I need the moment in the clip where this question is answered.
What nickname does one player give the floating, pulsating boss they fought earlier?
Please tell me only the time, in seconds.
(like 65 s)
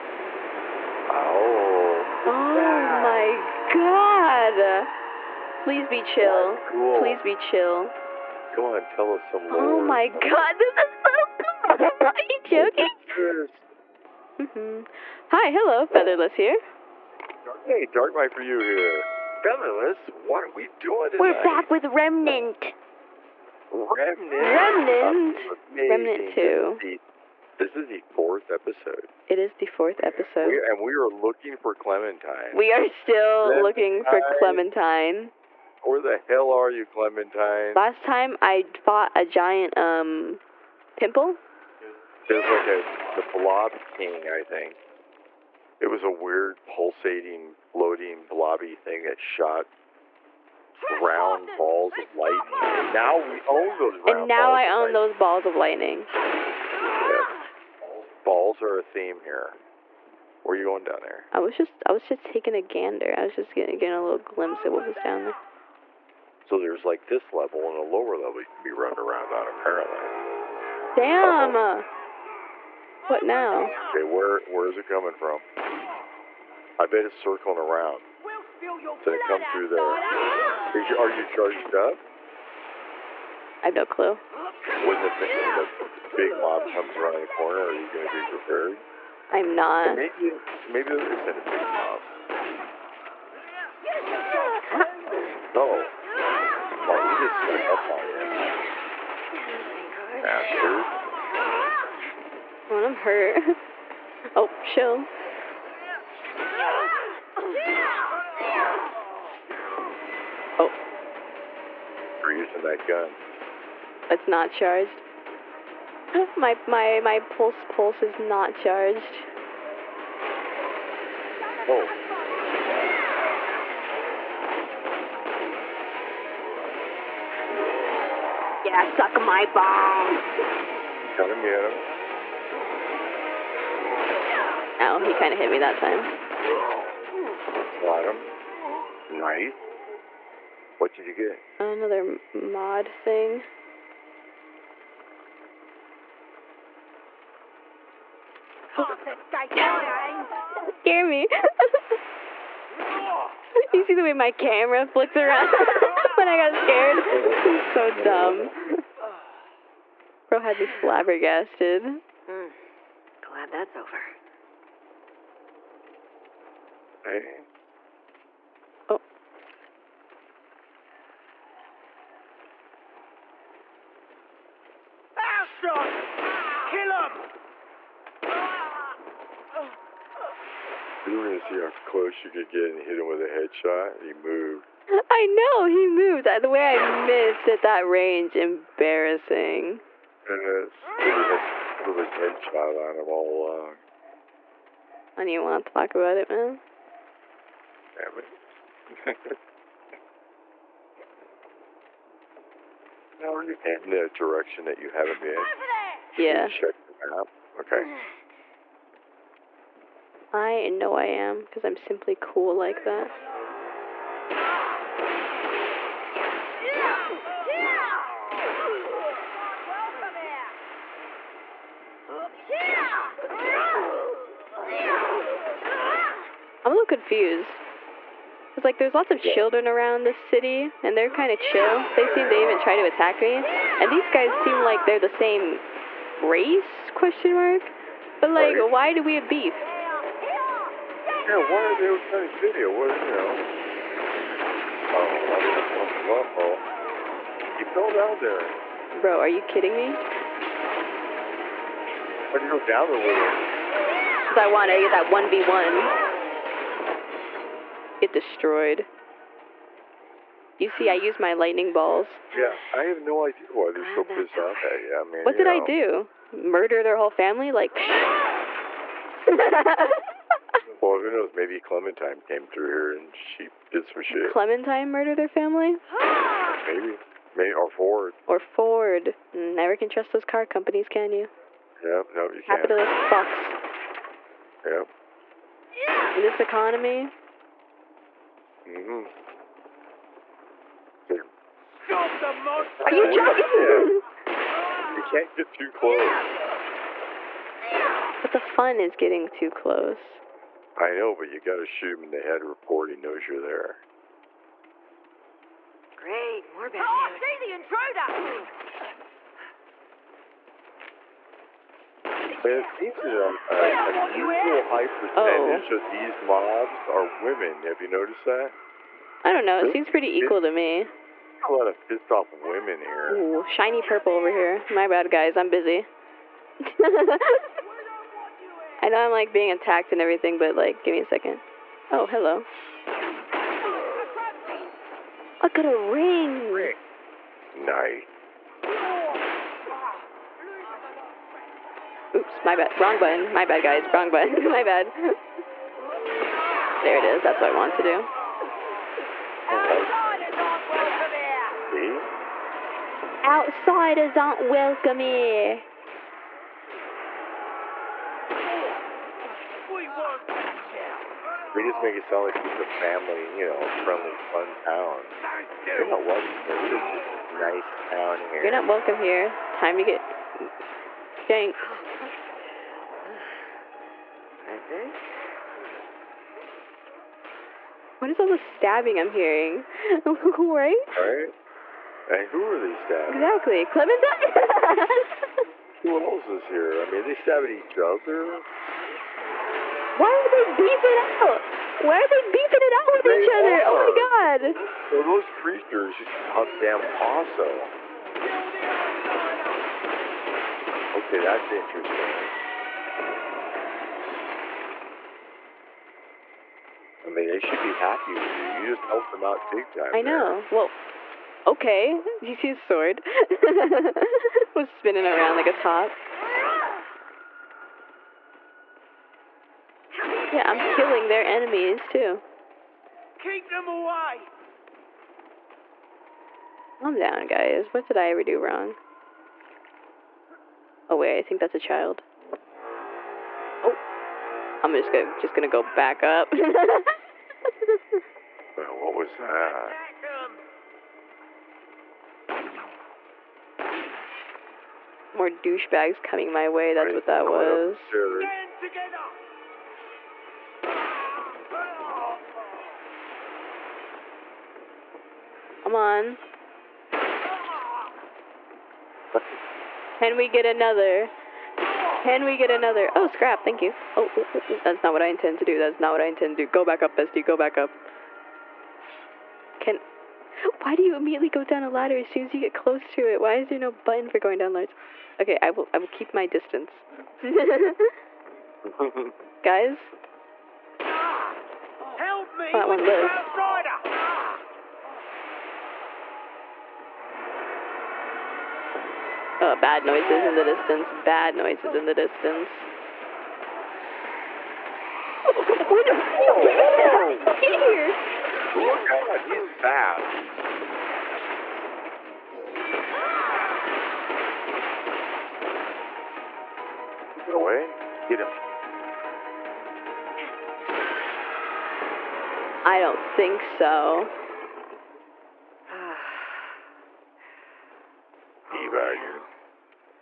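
43 s.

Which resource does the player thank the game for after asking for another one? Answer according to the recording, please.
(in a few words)
scrap.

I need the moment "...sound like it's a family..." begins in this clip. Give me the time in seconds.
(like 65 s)
362 s.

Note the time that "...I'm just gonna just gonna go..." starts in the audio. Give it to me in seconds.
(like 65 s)
434 s.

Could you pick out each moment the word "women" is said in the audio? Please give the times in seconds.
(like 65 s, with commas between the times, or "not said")
317 s, 322 s.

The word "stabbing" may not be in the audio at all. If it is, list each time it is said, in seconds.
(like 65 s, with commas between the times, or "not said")
378 s, 382 s, 387 s.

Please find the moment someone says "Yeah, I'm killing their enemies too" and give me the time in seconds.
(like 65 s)
420 s.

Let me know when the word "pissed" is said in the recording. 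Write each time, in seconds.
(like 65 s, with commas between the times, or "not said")
264 s, 321 s.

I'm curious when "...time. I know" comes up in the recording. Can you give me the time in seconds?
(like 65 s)
409 s.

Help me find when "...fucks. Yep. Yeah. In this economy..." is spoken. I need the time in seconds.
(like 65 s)
283 s.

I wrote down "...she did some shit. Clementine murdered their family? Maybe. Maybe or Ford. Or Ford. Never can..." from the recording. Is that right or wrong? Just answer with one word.
right.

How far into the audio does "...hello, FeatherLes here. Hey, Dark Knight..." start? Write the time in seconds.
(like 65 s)
15 s.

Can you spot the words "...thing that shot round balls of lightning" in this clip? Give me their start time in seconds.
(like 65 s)
48 s.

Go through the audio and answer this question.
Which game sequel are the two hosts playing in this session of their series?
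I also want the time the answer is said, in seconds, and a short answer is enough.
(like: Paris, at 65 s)
Remnant 2, at 25 s.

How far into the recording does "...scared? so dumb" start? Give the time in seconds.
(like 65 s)
156 s.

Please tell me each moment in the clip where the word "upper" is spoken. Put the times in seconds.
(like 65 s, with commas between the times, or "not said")
not said.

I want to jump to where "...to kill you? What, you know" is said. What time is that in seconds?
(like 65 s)
242 s.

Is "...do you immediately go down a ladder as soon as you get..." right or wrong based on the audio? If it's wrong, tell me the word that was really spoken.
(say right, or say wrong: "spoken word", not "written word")
right.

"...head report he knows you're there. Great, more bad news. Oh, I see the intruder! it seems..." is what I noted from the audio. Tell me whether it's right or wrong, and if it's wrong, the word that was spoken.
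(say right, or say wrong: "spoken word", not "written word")
right.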